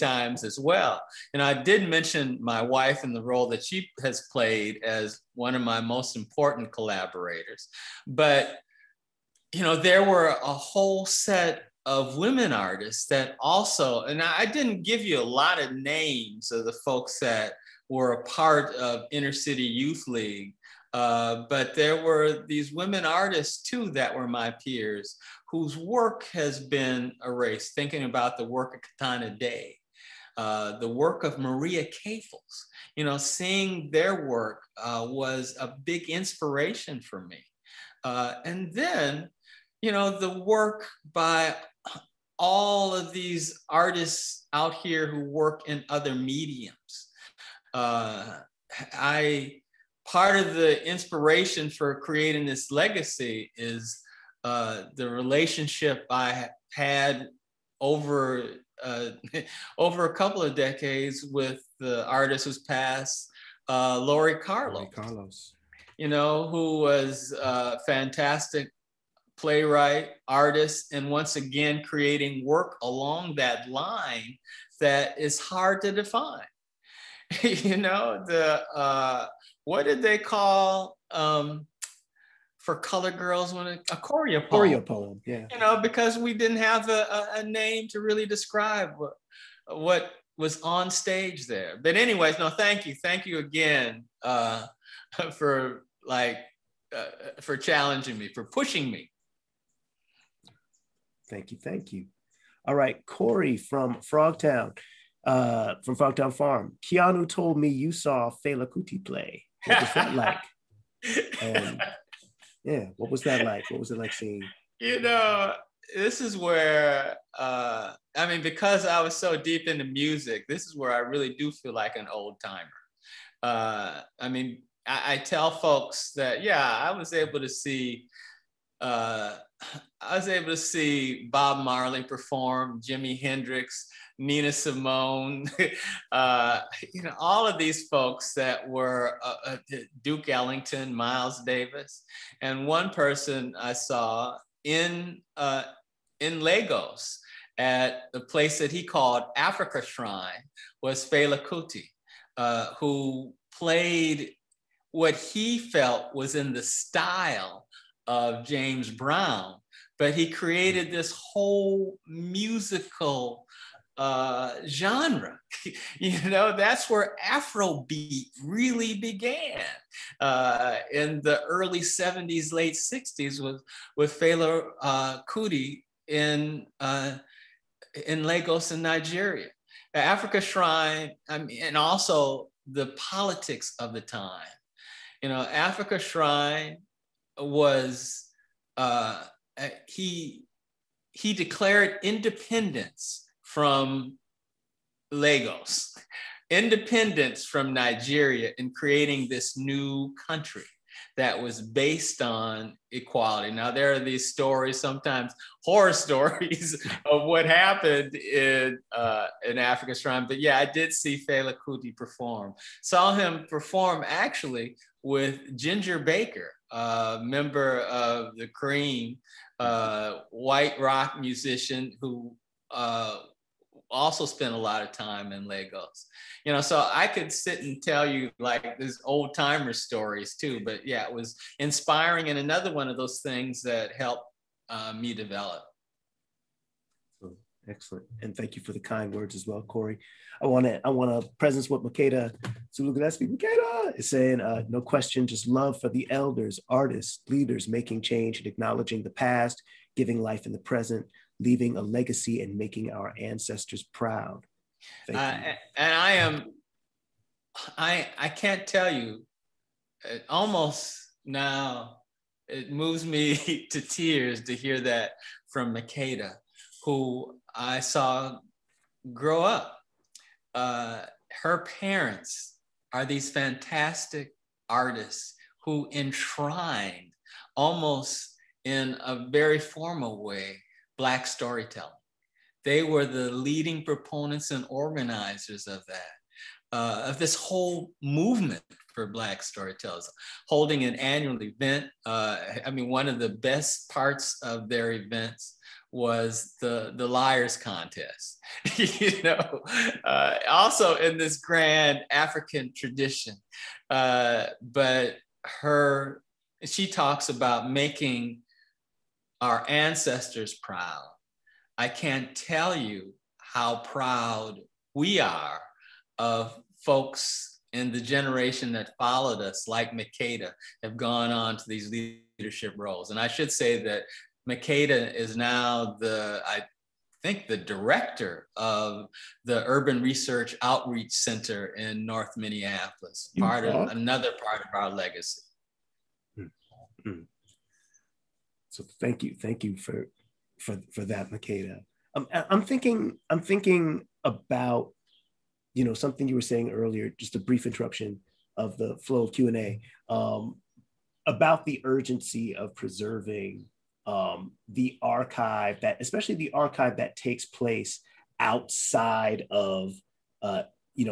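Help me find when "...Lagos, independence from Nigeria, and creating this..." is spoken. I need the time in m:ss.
3:15.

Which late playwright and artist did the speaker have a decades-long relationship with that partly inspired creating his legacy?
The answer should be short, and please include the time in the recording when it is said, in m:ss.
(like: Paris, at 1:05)
Laurie Carlos, at 1:03.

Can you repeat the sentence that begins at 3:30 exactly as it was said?
But yeah, I did see Fela Kuti perform.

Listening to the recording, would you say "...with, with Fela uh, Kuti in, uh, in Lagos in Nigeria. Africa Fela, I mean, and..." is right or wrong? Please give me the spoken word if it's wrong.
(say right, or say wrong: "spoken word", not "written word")
wrong: "Shrine", not "Fela".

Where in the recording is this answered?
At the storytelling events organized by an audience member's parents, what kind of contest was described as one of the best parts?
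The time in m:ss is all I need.
4:57.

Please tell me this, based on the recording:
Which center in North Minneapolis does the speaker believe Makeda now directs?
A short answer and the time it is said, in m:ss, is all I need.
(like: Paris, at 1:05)
Urban Research Outreach Center, at 5:29.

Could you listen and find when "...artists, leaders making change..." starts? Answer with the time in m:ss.
4:06.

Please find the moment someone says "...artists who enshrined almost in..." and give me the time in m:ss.
4:34.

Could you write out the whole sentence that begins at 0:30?
Uh, the work of Maria Cafels.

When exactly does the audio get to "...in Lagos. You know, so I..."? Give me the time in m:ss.
3:45.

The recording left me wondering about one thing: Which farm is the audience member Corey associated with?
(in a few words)
Frogtown Farm.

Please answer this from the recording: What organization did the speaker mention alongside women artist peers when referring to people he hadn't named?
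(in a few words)
Inner City Youth League.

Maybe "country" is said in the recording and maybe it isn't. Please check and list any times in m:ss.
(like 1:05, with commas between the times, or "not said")
3:20.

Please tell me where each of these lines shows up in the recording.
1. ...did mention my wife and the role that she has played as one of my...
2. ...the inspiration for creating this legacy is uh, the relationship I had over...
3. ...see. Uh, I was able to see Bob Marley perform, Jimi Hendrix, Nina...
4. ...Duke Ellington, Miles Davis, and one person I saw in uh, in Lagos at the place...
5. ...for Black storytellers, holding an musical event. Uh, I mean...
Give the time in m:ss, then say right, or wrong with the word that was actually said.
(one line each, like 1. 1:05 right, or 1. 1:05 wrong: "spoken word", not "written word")
1. 0:01 right
2. 0:50 right
3. 2:07 right
4. 2:20 right
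5. 4:48 wrong: "annual", not "musical".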